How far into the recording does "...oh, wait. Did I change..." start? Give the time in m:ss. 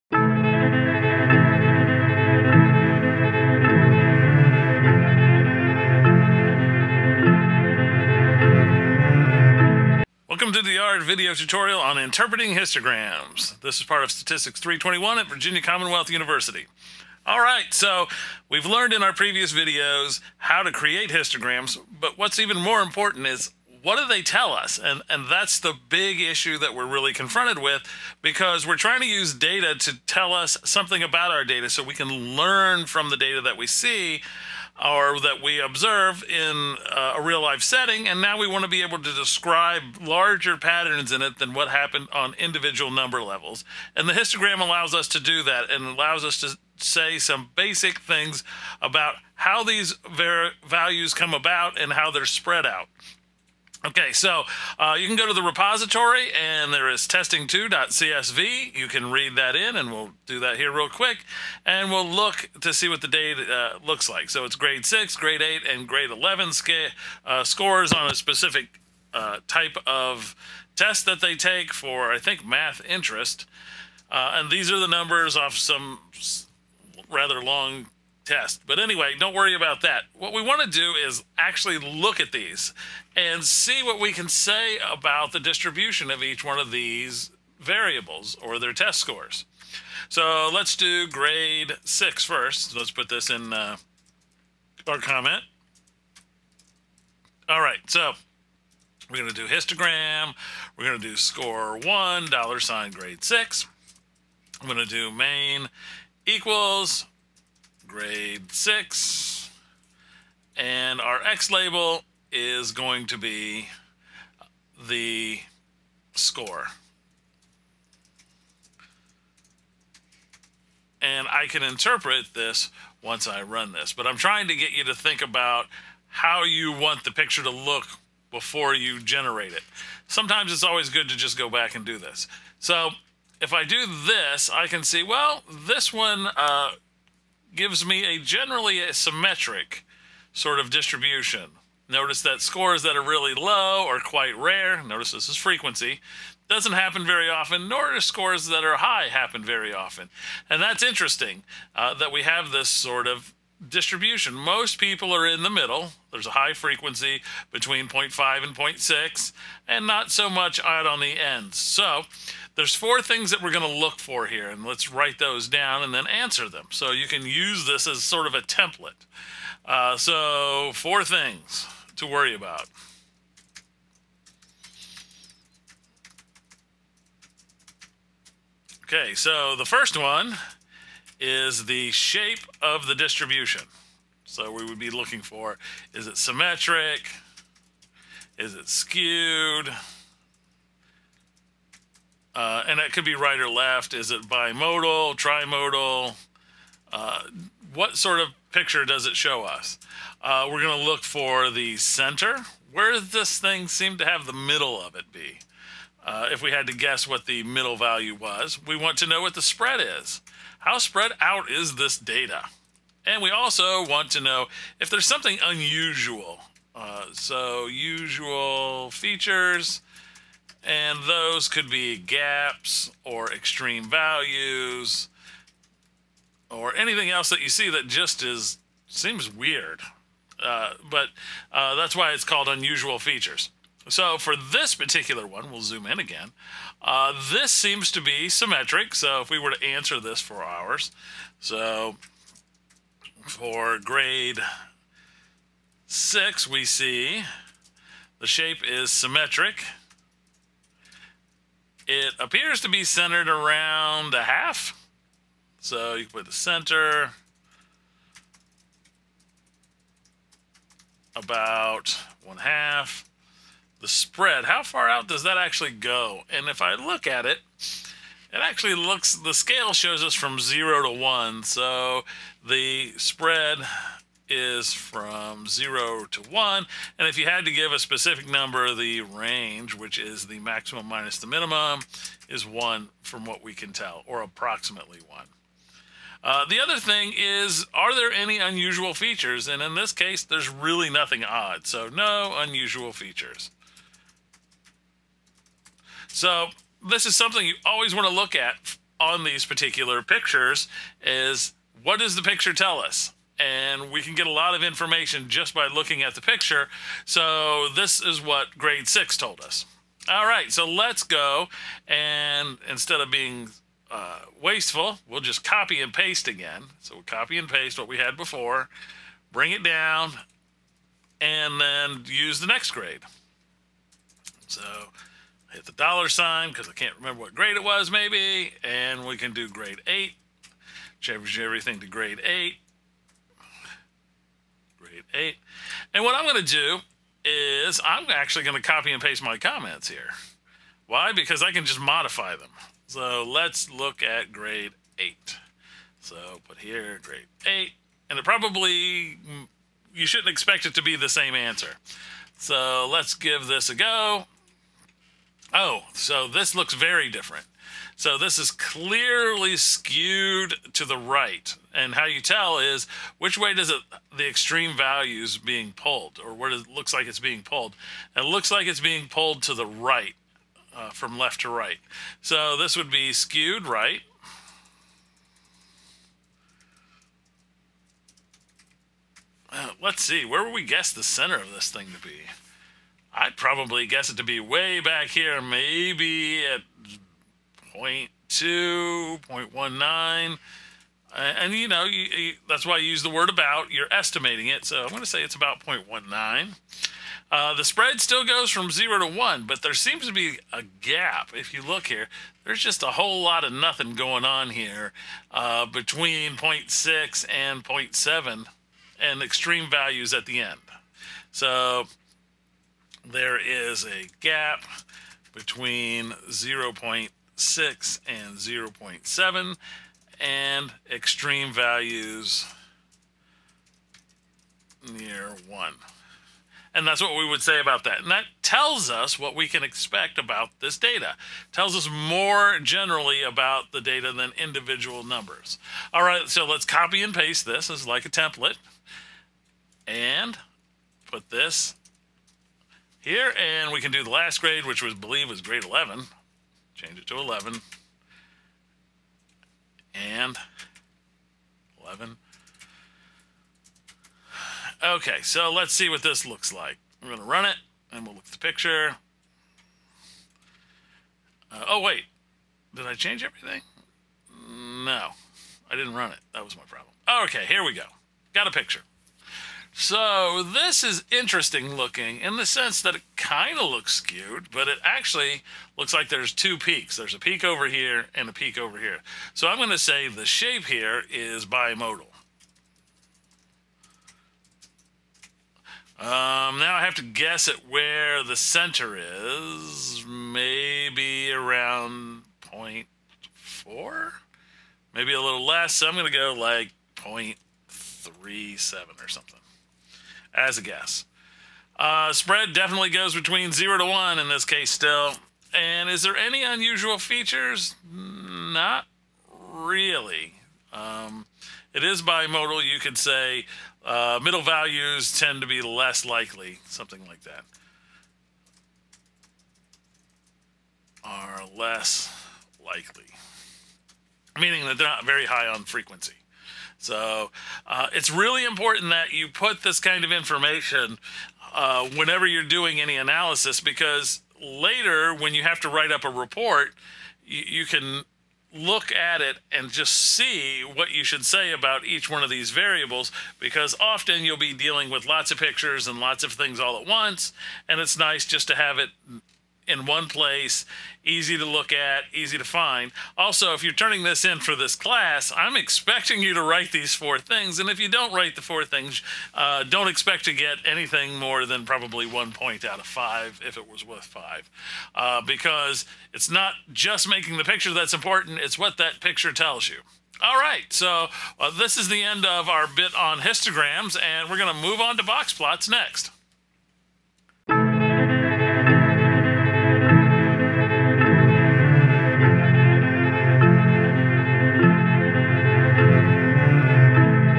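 7:41.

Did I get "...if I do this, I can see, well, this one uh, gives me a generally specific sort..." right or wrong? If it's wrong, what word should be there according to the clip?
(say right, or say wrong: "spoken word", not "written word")
wrong: "symmetric", not "specific".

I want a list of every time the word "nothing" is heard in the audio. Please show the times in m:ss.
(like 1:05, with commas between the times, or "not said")
4:50, 6:43.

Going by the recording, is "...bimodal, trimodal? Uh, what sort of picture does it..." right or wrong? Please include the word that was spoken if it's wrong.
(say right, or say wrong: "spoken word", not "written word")
right.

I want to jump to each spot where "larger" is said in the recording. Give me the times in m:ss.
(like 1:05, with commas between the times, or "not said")
0:40.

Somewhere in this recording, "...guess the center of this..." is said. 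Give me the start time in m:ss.
6:20.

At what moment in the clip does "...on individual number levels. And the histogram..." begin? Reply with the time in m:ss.
0:42.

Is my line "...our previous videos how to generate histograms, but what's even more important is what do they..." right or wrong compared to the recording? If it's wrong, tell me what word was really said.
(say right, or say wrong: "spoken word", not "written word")
wrong: "create", not "generate".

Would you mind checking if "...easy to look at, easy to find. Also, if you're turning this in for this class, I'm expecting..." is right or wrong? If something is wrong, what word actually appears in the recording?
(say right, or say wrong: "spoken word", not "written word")
right.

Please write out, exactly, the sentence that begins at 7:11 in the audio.
It tells us more generally about the data than individual numbers.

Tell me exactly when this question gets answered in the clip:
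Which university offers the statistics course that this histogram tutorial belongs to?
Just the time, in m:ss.
0:15.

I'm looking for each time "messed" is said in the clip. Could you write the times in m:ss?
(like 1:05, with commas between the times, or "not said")
not said.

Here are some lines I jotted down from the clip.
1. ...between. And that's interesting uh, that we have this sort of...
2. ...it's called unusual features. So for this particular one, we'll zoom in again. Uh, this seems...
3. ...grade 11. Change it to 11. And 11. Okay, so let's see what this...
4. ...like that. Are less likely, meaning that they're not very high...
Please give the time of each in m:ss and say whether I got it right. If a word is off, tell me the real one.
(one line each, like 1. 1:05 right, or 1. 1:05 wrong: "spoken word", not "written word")
1. 2:29 wrong: "often", not "between"
2. 3:52 right
3. 7:25 right
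4. 8:37 right.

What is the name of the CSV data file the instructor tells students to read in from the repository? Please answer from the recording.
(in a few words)
testing2.csv.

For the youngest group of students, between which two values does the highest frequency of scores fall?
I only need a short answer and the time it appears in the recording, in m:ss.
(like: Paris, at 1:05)
0.5 and 0.6, at 2:37.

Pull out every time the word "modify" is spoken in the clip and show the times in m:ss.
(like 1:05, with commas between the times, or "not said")
5:41.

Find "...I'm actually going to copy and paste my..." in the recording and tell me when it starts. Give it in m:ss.
5:37.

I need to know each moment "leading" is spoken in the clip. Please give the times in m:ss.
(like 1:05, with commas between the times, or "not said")
not said.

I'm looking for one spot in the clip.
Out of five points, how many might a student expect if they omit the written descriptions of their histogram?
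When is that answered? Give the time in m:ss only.
9:22.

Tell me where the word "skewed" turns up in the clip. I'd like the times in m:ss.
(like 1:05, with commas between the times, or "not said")
3:08, 5:59, 6:13, 7:53.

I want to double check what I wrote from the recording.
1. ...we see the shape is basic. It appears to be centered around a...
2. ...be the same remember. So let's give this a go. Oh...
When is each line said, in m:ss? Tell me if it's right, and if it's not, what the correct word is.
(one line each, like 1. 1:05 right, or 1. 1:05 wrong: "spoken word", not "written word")
1. 4:06 wrong: "symmetric", not "basic"
2. 5:50 wrong: "answer", not "remember".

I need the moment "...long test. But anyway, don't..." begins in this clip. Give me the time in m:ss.
1:17.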